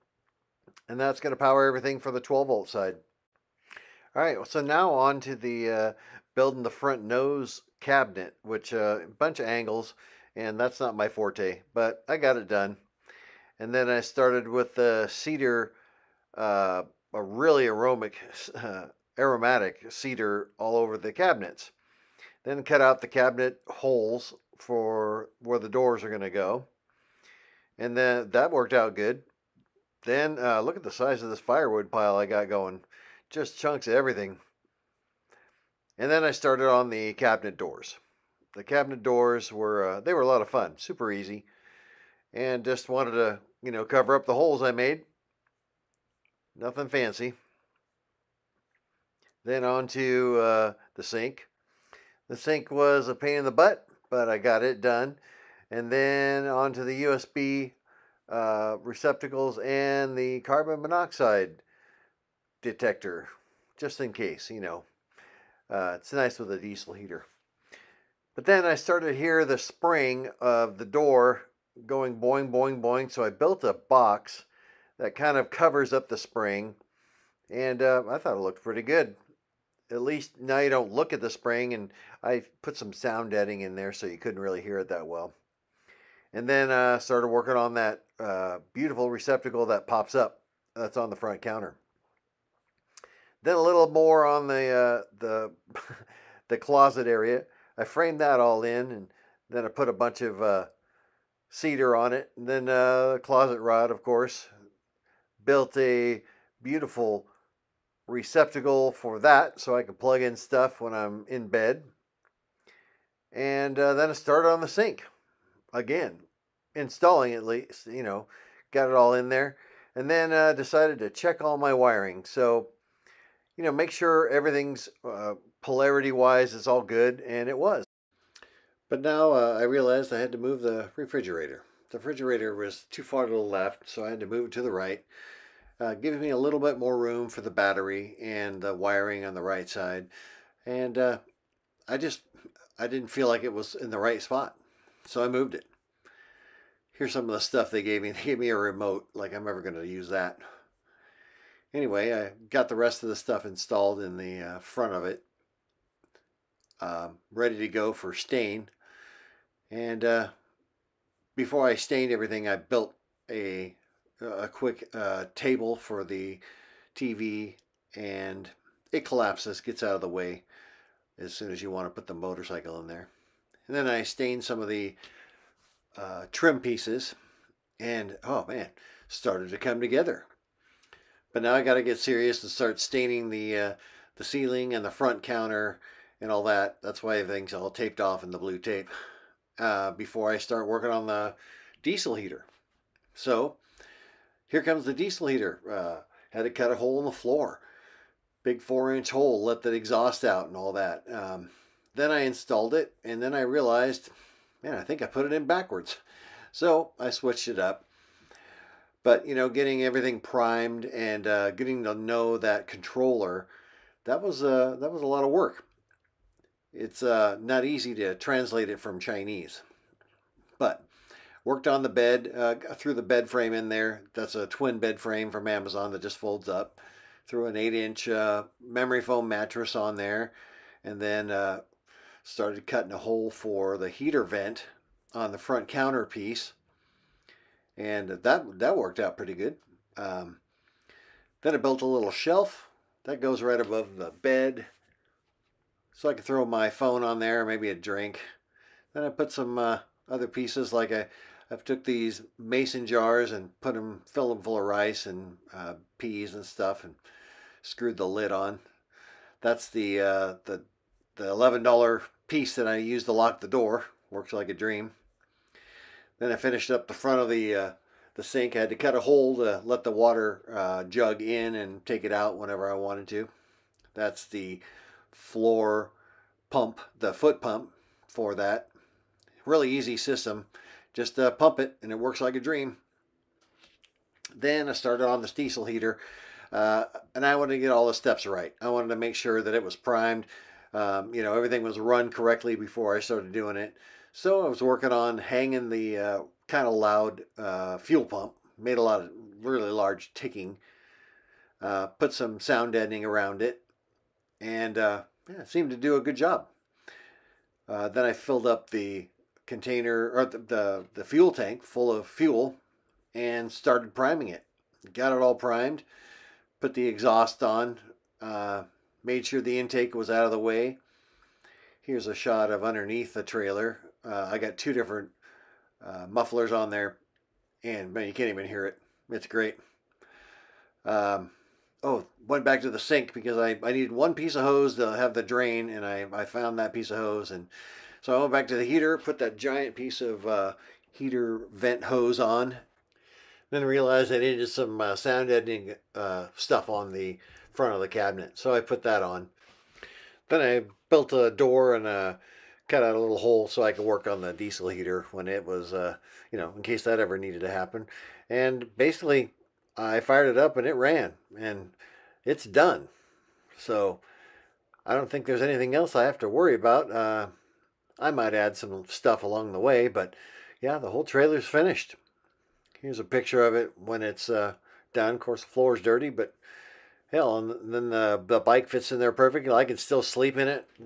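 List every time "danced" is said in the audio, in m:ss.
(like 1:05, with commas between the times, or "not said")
not said.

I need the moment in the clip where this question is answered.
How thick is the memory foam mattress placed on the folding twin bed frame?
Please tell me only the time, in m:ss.
3:47.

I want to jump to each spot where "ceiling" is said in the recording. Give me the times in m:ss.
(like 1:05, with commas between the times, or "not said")
3:04.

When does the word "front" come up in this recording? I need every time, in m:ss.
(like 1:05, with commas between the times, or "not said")
0:06, 1:31, 2:34, 3:04, 3:55, 4:26, 5:47.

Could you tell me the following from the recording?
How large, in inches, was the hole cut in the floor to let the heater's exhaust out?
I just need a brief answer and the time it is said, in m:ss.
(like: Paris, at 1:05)
4 inches, at 3:18.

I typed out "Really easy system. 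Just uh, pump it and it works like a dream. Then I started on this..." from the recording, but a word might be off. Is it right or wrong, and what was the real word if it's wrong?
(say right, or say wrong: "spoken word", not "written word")
right.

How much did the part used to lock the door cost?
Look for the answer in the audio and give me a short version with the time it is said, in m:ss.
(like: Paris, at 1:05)
$11, at 4:21.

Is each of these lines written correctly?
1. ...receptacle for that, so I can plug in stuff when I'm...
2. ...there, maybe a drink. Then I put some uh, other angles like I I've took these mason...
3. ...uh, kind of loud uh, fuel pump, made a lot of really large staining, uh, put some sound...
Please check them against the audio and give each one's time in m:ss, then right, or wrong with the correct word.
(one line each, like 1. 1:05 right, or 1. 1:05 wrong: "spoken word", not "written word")
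1. 1:48 right
2. 4:07 wrong: "pieces", not "angles"
3. 4:55 wrong: "ticking", not "staining".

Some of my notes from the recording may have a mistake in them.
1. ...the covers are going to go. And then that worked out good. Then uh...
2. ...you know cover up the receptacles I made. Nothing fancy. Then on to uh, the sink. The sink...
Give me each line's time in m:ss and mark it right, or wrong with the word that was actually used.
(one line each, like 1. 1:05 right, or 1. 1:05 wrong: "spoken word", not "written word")
1. 0:25 wrong: "doors", not "covers"
2. 0:43 wrong: "holes", not "receptacles".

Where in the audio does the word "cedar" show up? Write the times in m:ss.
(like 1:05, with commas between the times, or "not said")
0:15, 0:19, 1:41.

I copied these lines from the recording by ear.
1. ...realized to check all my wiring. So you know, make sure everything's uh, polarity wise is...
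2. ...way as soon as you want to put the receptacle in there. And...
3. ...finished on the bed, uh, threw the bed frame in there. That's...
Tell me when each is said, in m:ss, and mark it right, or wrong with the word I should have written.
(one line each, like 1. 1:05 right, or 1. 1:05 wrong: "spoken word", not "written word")
1. 2:00 wrong: "decided", not "realized"
2. 2:50 wrong: "motorcycle", not "receptacle"
3. 3:41 wrong: "worked", not "finished".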